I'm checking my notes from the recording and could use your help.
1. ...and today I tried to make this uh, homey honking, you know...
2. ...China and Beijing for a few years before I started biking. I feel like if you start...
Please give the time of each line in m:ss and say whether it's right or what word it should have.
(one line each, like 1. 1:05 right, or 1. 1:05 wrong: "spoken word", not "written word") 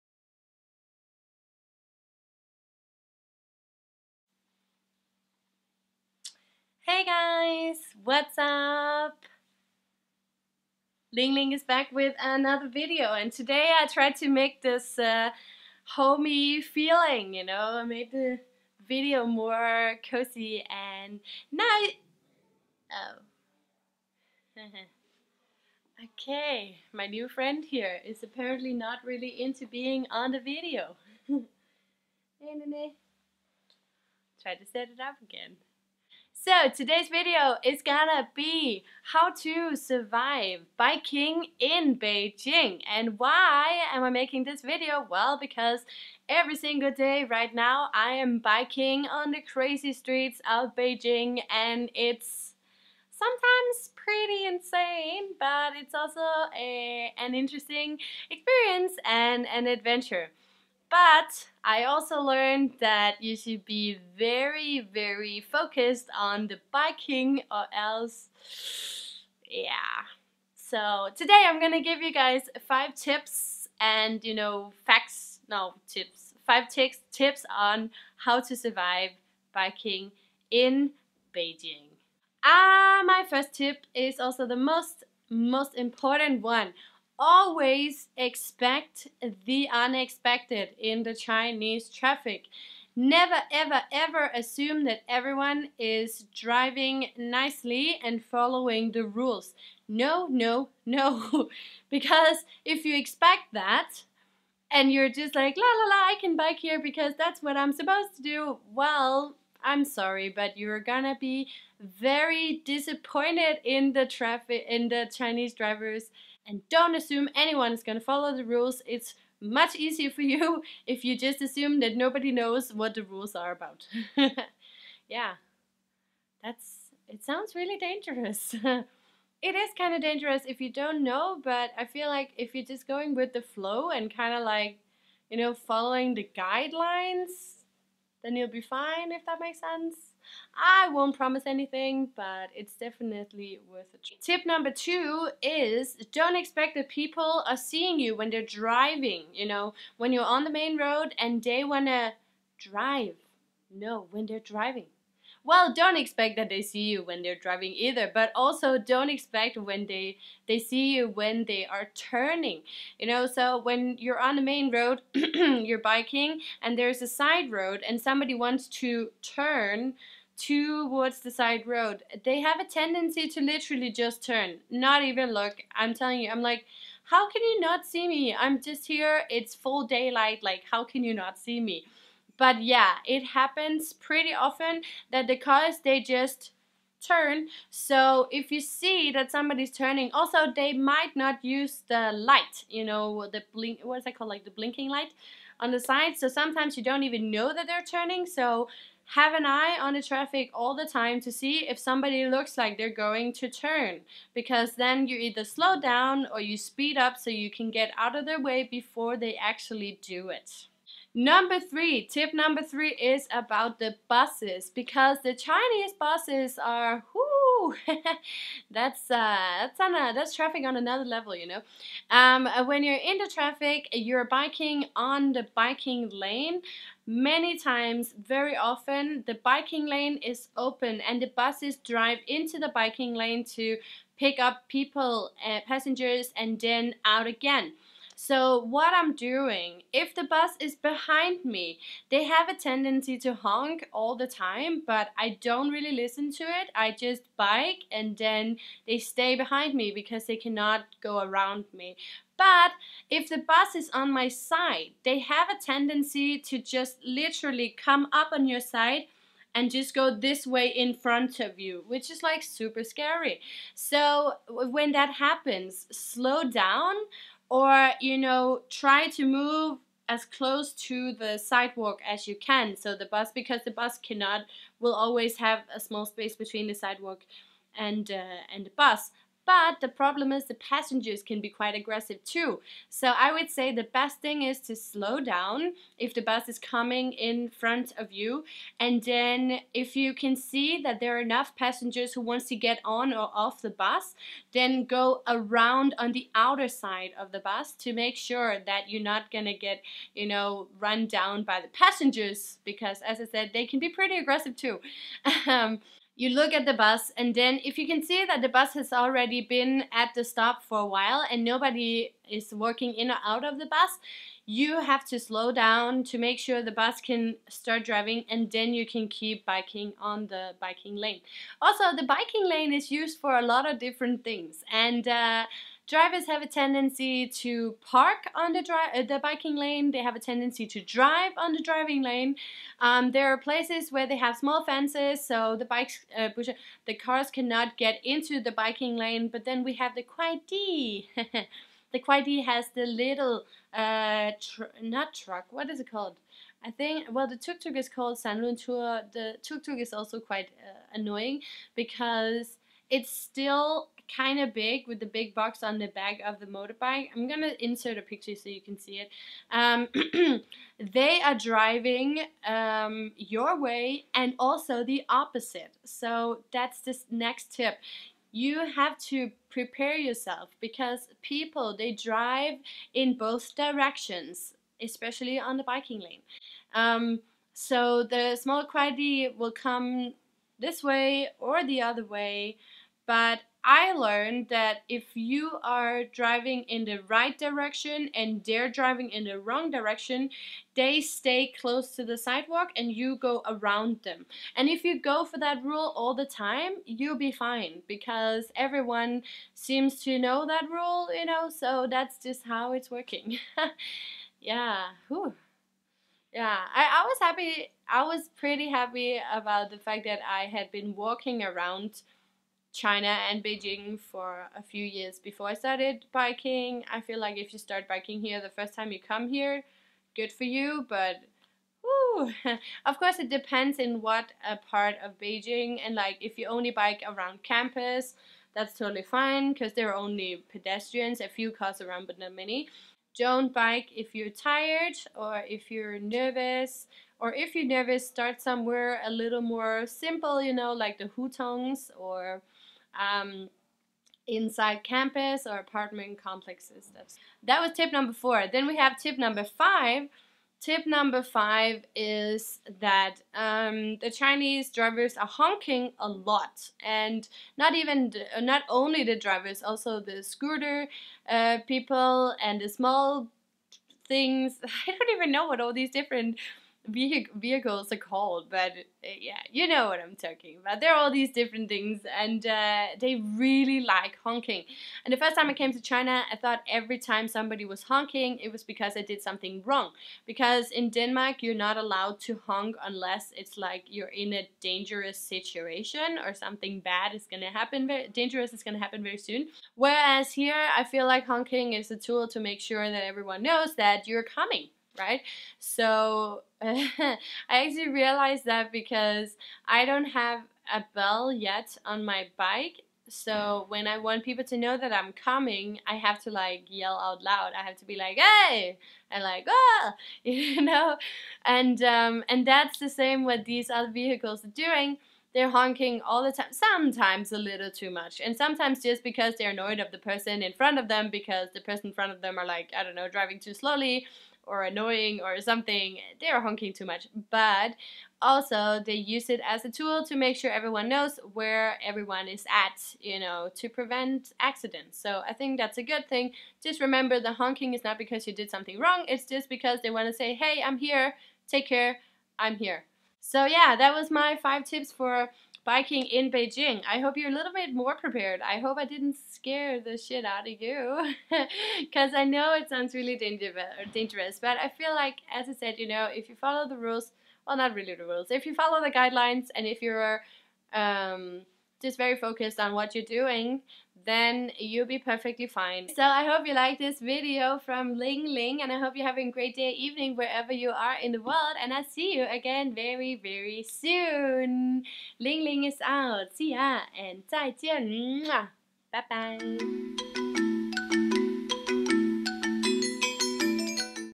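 1. 0:13 wrong: "feeling", not "honking"
2. 6:52 right.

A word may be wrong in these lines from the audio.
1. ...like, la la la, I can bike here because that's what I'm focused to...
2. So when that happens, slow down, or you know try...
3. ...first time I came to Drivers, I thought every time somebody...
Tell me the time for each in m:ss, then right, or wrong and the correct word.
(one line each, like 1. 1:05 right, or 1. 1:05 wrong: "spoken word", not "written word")
1. 1:45 wrong: "supposed", not "focused"
2. 4:23 right
3. 7:55 wrong: "China", not "Drivers".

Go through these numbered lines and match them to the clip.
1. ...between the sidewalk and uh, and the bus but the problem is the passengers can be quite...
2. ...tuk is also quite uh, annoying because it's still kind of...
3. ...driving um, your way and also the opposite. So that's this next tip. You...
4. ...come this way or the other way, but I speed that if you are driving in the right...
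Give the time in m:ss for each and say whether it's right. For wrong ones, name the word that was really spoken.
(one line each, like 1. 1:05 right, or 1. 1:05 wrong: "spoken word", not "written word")
1. 4:36 right
2. 5:49 right
3. 6:01 right
4. 6:19 wrong: "learned", not "speed".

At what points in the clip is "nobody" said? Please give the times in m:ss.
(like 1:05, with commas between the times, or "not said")
2:01, 5:11.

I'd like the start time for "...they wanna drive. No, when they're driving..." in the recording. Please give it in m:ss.
2:31.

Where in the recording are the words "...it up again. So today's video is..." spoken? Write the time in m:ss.
0:34.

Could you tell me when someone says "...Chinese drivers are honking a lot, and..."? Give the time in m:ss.
7:34.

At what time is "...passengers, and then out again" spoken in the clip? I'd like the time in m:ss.
3:55.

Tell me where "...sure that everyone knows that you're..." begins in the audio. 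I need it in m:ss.
8:12.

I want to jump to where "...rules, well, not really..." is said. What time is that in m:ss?
9:16.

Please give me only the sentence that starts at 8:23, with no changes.
So when I want people to know that I'm coming, I have to like yell out loud.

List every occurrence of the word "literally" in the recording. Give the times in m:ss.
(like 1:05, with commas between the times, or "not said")
2:53, 4:17.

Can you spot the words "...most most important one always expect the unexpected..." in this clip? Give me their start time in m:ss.
1:24.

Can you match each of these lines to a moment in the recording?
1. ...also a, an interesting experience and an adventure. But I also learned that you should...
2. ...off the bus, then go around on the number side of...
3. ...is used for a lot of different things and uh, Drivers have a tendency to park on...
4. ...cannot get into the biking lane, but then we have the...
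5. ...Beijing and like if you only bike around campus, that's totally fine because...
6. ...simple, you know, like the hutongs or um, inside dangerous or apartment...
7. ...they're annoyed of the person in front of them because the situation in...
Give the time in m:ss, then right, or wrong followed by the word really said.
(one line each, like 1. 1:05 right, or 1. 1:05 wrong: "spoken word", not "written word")
1. 0:55 right
2. 4:53 wrong: "outer", not "number"
3. 5:22 right
4. 5:37 right
5. 7:05 right
6. 7:19 wrong: "campus", not "dangerous"
7. 8:39 wrong: "person", not "situation".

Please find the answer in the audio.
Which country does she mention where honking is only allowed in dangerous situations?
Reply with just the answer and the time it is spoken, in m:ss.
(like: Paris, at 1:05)
Denmark, at 8:00.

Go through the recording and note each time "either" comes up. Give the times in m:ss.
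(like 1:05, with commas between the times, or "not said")
2:37, 3:25.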